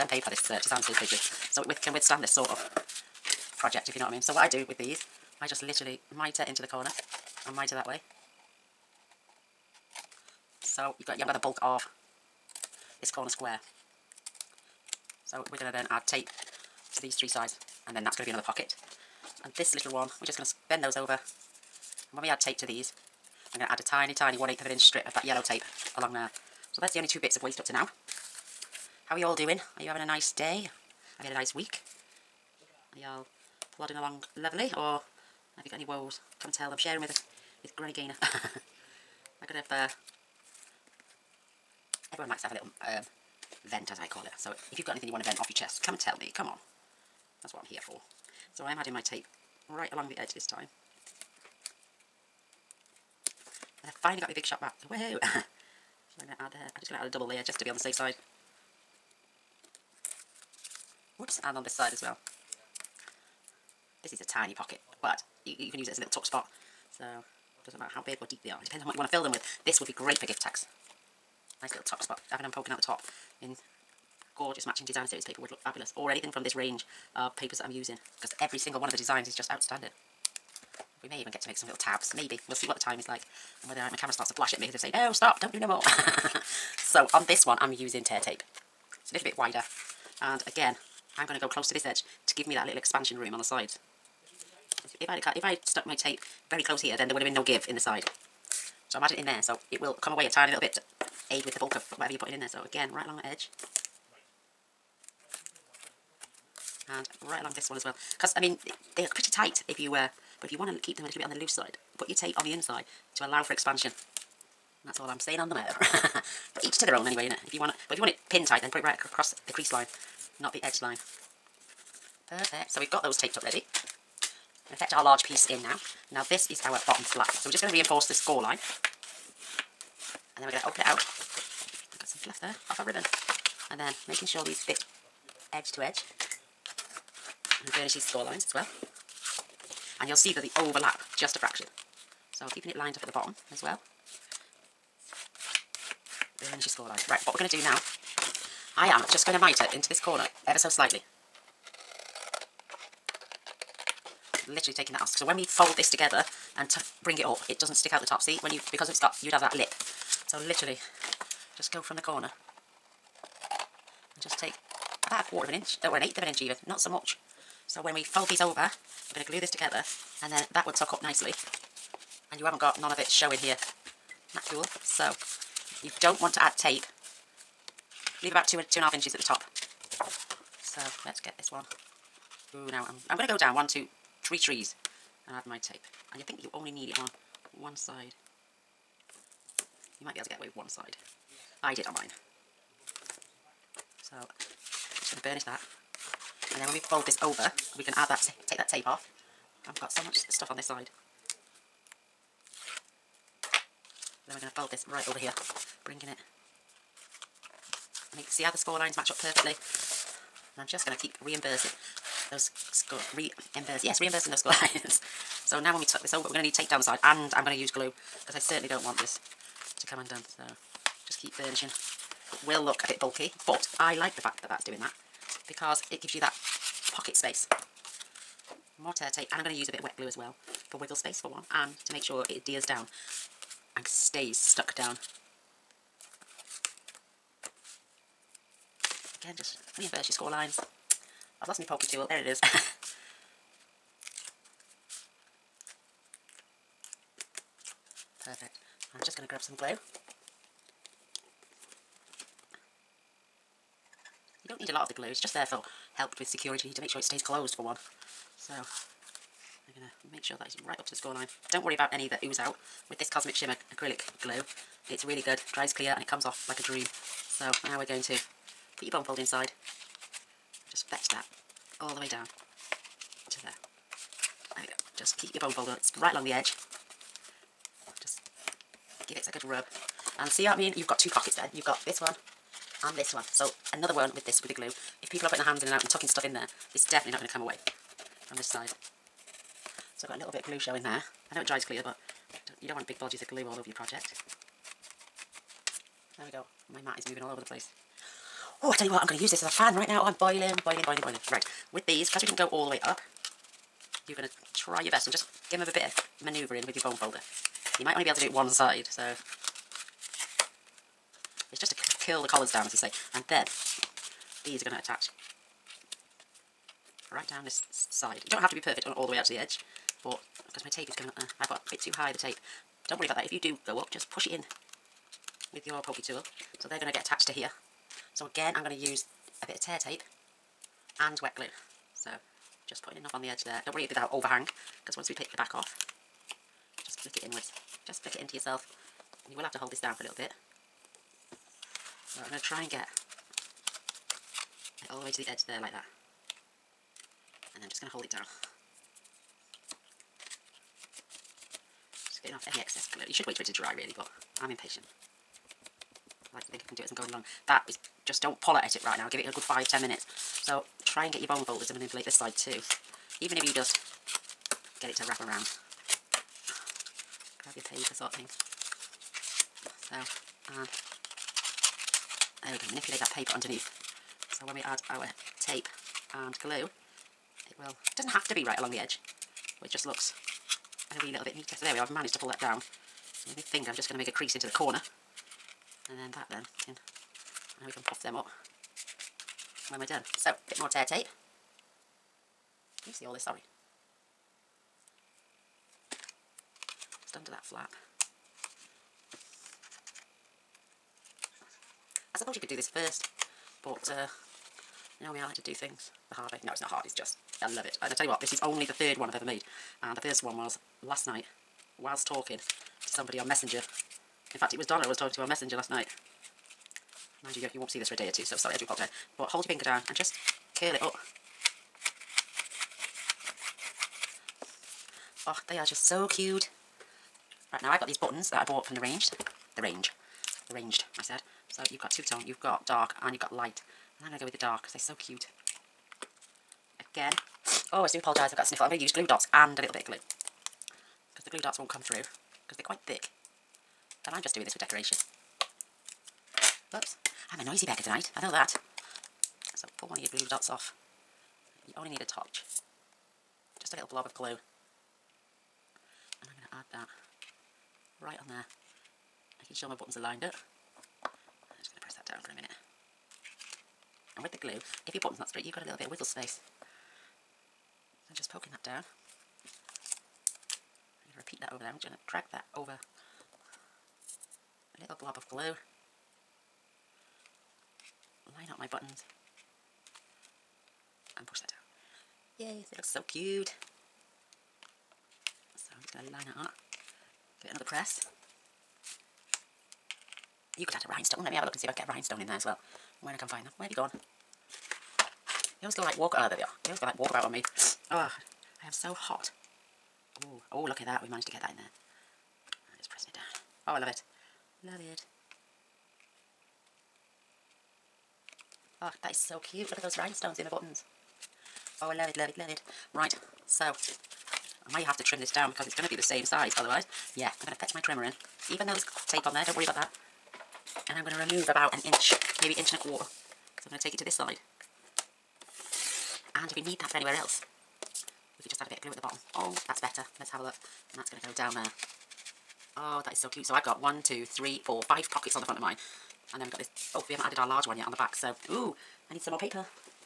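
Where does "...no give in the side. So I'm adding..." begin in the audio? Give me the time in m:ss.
1:37.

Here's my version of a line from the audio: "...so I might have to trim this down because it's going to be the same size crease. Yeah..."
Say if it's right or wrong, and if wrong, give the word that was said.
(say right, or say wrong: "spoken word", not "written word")
wrong: "otherwise", not "crease".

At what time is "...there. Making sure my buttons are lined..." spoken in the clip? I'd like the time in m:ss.
7:38.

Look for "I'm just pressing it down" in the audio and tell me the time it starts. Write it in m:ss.
8:22.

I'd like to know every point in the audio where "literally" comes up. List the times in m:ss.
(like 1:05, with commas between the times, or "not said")
0:05, 2:34, 2:40.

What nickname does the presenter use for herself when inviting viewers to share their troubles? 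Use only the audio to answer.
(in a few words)
Granny Gaynor.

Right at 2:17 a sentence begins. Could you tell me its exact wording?
And burnish these score lines as well.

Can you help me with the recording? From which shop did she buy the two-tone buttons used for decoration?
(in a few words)
The Range.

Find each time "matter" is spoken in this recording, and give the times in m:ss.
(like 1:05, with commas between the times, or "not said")
1:07, 1:55.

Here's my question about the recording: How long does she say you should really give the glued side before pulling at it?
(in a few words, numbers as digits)
5 to 10 minutes.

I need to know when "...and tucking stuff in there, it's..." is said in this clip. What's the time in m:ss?
4:45.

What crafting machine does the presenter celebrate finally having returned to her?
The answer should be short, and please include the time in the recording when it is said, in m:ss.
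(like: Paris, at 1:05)
Big Shot, at 0:54.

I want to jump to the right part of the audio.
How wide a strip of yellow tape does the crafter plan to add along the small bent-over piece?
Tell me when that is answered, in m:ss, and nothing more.
0:24.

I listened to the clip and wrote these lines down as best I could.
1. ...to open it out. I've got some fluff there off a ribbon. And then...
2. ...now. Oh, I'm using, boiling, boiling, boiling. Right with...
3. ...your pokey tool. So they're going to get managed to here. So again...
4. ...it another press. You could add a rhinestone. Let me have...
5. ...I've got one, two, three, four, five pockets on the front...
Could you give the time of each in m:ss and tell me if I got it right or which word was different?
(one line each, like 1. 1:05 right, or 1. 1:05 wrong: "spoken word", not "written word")
1. 2:10 right
2. 4:59 wrong: "boiling", not "using"
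3. 5:25 wrong: "attached", not "managed"
4. 8:07 right
5. 8:53 right.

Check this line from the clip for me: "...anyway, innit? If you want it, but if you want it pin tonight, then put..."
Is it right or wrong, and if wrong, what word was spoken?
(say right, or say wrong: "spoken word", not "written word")
wrong: "tight", not "tonight".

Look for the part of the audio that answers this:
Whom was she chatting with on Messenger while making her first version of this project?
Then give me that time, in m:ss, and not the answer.
6:54.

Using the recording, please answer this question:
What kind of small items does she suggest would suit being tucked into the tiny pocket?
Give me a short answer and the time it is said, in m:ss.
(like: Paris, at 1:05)
gift tags, at 1:10.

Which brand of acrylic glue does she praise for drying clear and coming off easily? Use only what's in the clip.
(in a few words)
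Cosmic Shimmer.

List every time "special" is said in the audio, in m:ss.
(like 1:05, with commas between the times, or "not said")
not said.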